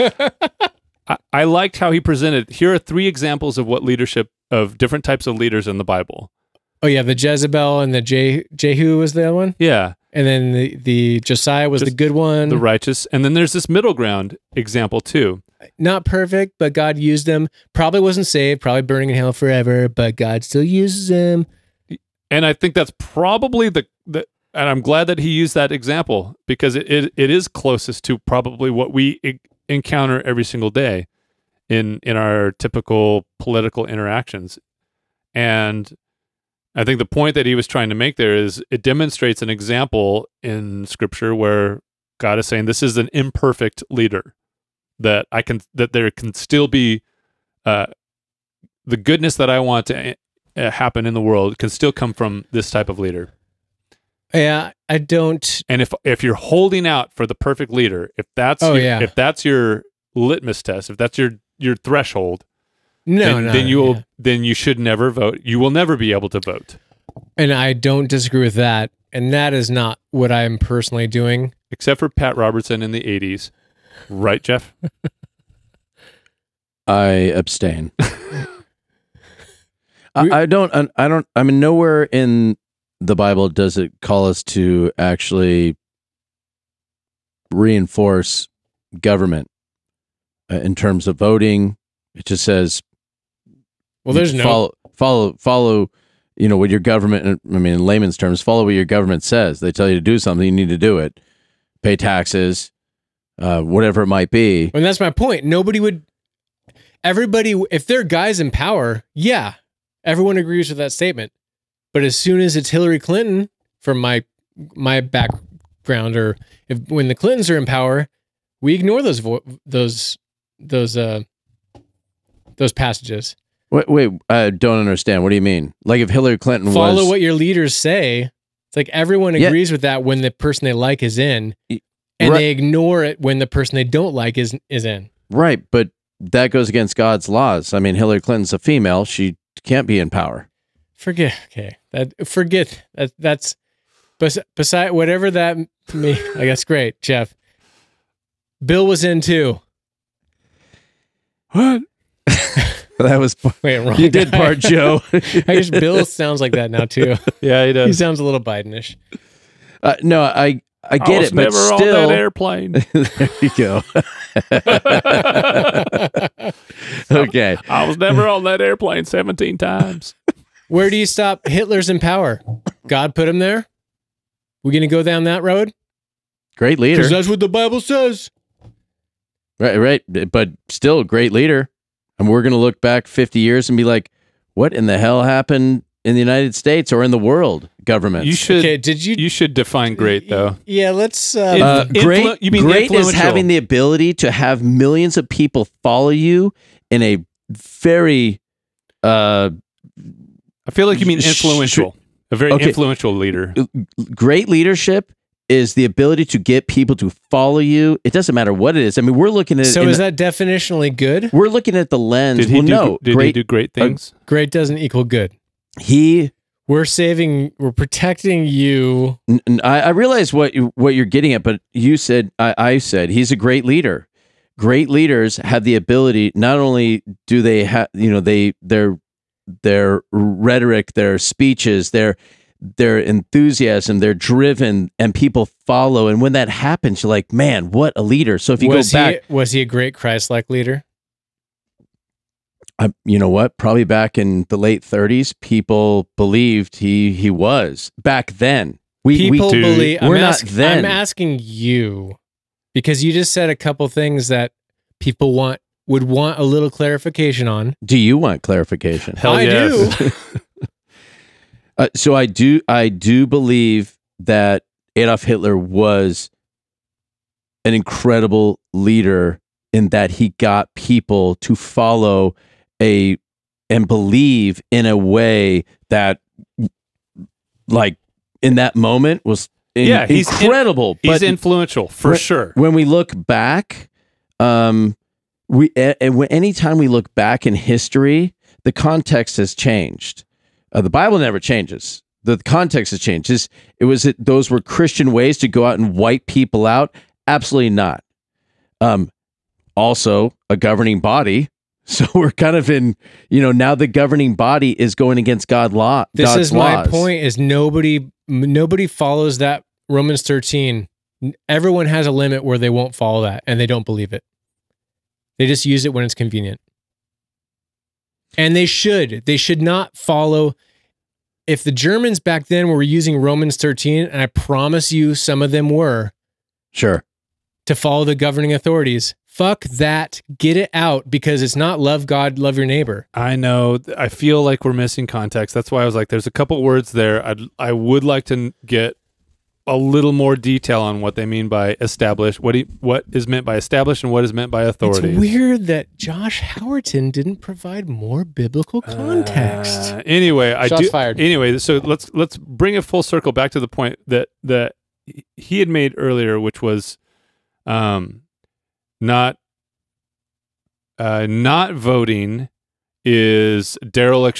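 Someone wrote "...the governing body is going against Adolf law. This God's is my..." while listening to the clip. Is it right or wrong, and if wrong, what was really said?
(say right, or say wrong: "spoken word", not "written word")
wrong: "God", not "Adolf".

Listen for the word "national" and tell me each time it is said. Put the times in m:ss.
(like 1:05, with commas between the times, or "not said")
not said.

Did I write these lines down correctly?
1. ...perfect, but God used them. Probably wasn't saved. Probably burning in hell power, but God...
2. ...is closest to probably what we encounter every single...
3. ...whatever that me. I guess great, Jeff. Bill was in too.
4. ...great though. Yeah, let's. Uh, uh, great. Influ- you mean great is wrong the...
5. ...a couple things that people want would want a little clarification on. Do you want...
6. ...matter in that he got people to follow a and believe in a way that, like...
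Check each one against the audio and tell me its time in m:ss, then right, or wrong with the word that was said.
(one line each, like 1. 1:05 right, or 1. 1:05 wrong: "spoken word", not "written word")
1. 0:16 wrong: "forever", not "power"
2. 0:27 right
3. 2:24 right
4. 3:09 wrong: "having", not "wrong"
5. 4:13 right
6. 4:28 wrong: "leader", not "matter".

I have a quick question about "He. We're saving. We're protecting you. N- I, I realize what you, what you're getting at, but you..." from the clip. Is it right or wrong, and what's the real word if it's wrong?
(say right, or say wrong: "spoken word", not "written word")
right.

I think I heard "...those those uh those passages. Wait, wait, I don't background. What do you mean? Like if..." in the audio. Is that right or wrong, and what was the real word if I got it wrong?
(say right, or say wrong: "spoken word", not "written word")
wrong: "understand", not "background".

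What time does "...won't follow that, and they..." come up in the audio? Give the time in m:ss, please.
5:12.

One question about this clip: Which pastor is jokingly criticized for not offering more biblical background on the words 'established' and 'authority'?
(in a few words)
Josh Howerton.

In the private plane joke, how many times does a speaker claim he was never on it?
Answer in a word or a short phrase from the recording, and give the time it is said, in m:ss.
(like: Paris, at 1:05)
17, at 2:49.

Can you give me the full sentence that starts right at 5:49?
Uh, anyway, I Shots do fired.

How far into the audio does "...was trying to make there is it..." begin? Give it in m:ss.
0:37.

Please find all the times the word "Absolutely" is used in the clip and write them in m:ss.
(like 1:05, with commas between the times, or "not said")
4:57.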